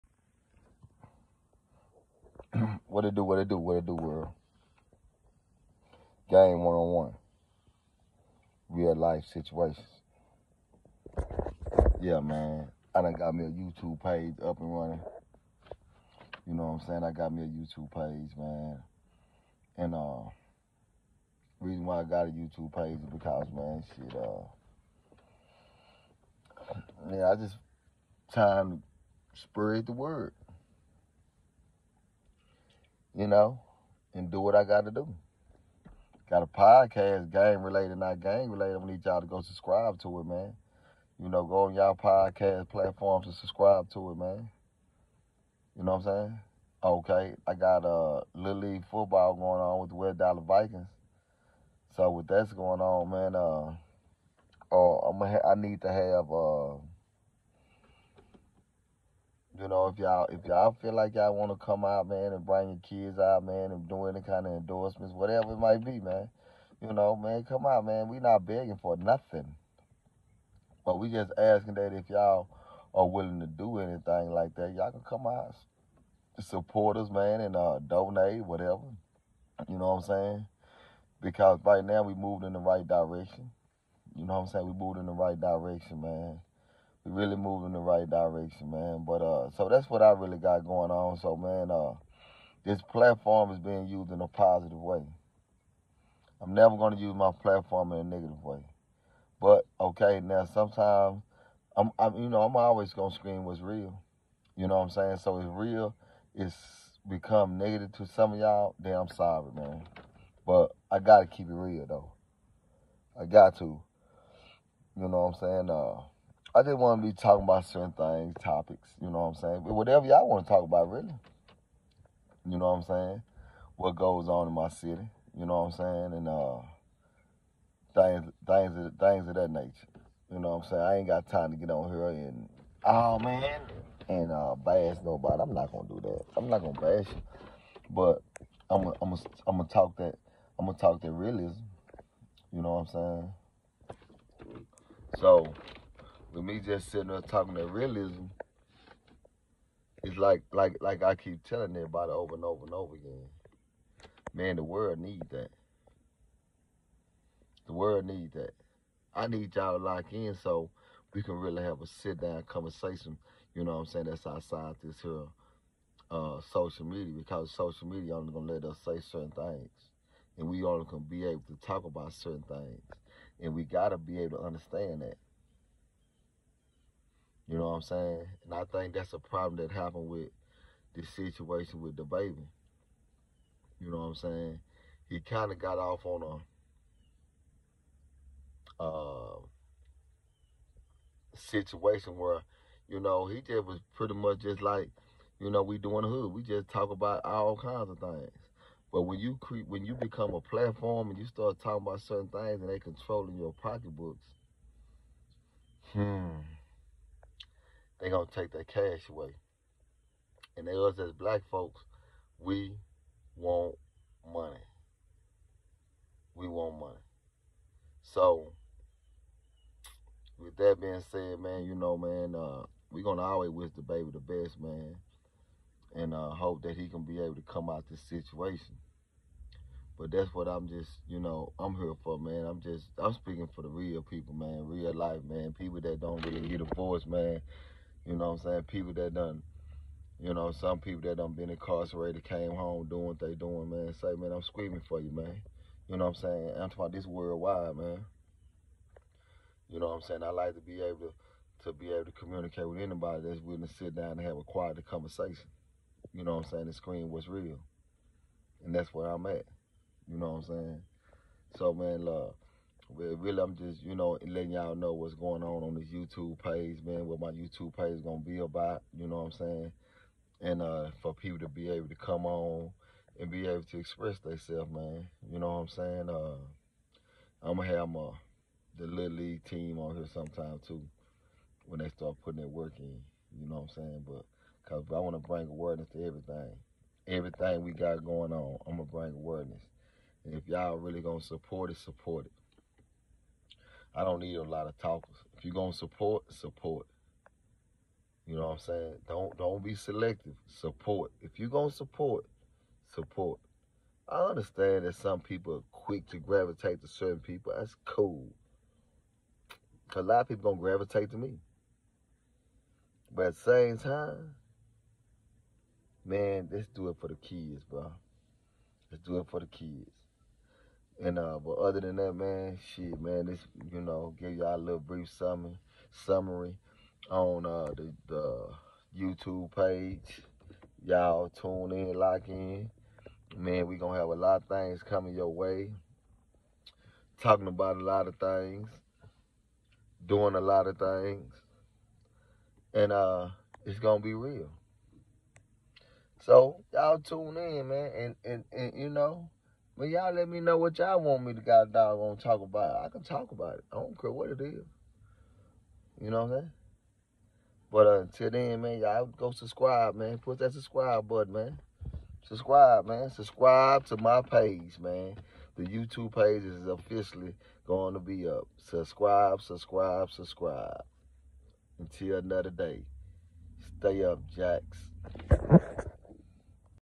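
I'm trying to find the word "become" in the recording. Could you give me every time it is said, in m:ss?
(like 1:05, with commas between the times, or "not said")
1:47, 3:19.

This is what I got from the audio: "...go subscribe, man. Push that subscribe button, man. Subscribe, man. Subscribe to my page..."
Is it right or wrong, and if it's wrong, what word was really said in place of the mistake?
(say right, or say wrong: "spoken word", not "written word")
right.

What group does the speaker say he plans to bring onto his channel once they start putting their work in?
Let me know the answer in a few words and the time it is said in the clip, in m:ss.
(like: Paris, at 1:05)
The Little League team, at 4:38.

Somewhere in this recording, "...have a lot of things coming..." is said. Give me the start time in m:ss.
5:33.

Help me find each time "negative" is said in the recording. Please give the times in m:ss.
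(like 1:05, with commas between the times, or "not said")
1:38, 1:47.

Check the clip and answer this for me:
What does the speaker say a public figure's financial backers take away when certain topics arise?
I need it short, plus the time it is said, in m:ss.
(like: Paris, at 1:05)
Their cash, at 3:28.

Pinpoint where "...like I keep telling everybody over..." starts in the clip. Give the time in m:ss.
2:30.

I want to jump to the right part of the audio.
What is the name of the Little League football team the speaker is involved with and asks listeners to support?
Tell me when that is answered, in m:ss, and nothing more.
0:49.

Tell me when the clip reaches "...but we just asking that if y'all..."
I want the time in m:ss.
1:10.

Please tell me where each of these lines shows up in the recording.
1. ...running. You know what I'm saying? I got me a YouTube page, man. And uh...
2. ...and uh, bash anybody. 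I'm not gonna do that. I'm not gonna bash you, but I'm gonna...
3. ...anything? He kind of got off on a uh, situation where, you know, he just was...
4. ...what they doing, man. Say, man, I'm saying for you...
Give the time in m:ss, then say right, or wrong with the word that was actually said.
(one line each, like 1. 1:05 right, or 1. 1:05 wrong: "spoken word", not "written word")
1. 0:14 right
2. 2:14 wrong: "nobody", not "anybody"
3. 3:04 wrong: "saying", not "anything"
4. 4:03 wrong: "screaming", not "saying".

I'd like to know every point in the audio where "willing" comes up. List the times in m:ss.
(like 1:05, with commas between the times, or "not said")
1:13, 4:13.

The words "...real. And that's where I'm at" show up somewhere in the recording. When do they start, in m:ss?
4:17.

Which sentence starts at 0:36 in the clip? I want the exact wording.
Got a podcast, game related, not game related.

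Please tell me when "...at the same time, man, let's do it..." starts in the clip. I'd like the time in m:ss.
5:13.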